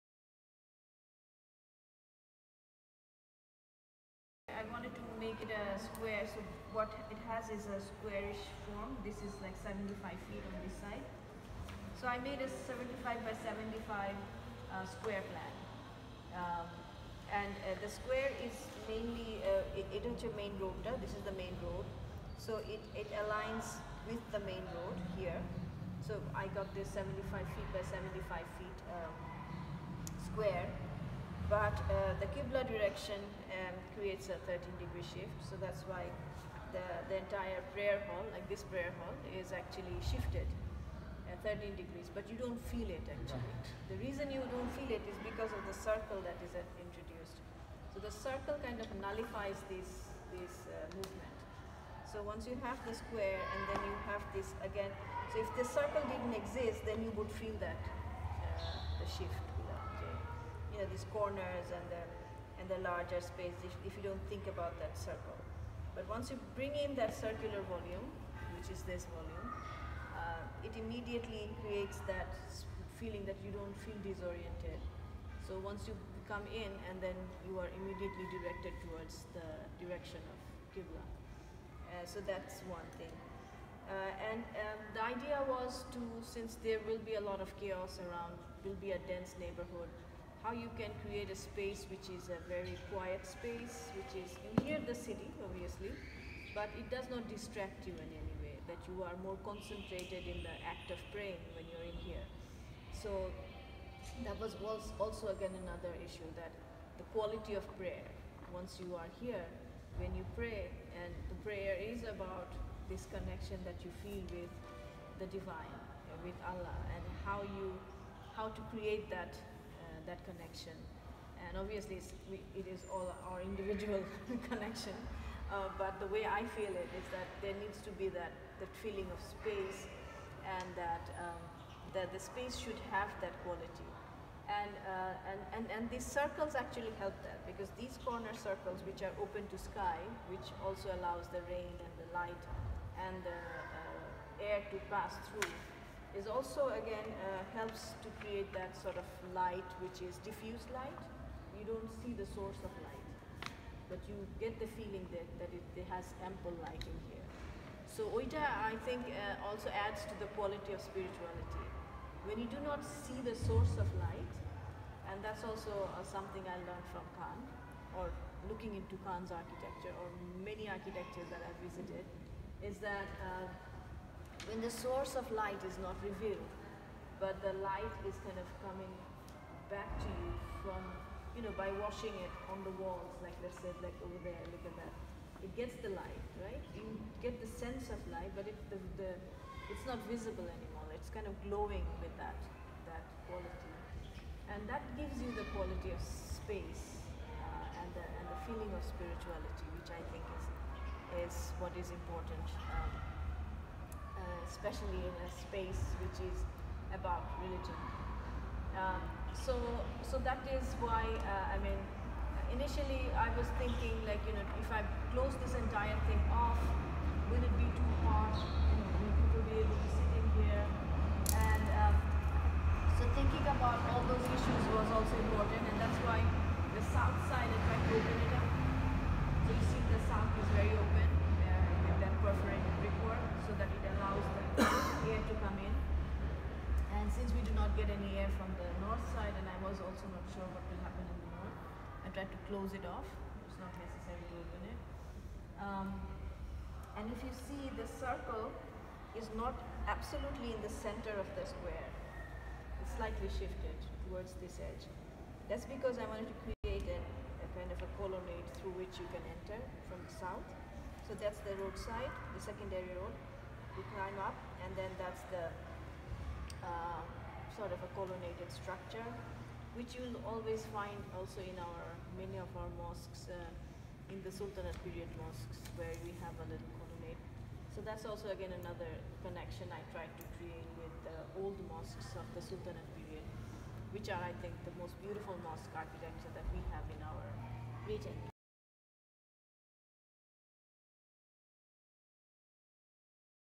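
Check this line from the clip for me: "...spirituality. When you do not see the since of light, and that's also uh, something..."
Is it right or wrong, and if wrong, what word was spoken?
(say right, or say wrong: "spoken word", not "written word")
wrong: "source", not "since".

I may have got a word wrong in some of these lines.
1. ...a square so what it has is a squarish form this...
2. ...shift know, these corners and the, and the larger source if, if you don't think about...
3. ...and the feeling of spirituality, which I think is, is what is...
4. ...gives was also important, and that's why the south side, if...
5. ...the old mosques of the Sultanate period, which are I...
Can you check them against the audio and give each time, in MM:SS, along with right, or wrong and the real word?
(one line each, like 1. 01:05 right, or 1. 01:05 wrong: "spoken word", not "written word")
1. 00:05 right
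2. 00:59 wrong: "space", not "source"
3. 03:18 right
4. 03:44 wrong: "issues", not "gives"
5. 04:41 right.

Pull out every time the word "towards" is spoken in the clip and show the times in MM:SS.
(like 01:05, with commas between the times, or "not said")
01:18, 04:14.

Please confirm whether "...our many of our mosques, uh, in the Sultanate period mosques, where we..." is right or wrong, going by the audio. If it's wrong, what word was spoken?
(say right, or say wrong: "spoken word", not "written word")
right.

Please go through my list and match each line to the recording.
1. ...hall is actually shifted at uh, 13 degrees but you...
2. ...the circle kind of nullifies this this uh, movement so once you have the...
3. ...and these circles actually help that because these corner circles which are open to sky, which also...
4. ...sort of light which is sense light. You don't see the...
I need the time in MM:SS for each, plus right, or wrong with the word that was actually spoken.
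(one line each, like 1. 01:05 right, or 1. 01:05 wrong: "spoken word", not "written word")
1. 00:39 right
2. 00:47 right
3. 02:15 right
4. 02:28 wrong: "diffuse", not "sense".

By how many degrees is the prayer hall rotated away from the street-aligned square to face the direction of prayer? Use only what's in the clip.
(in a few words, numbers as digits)
13 degrees.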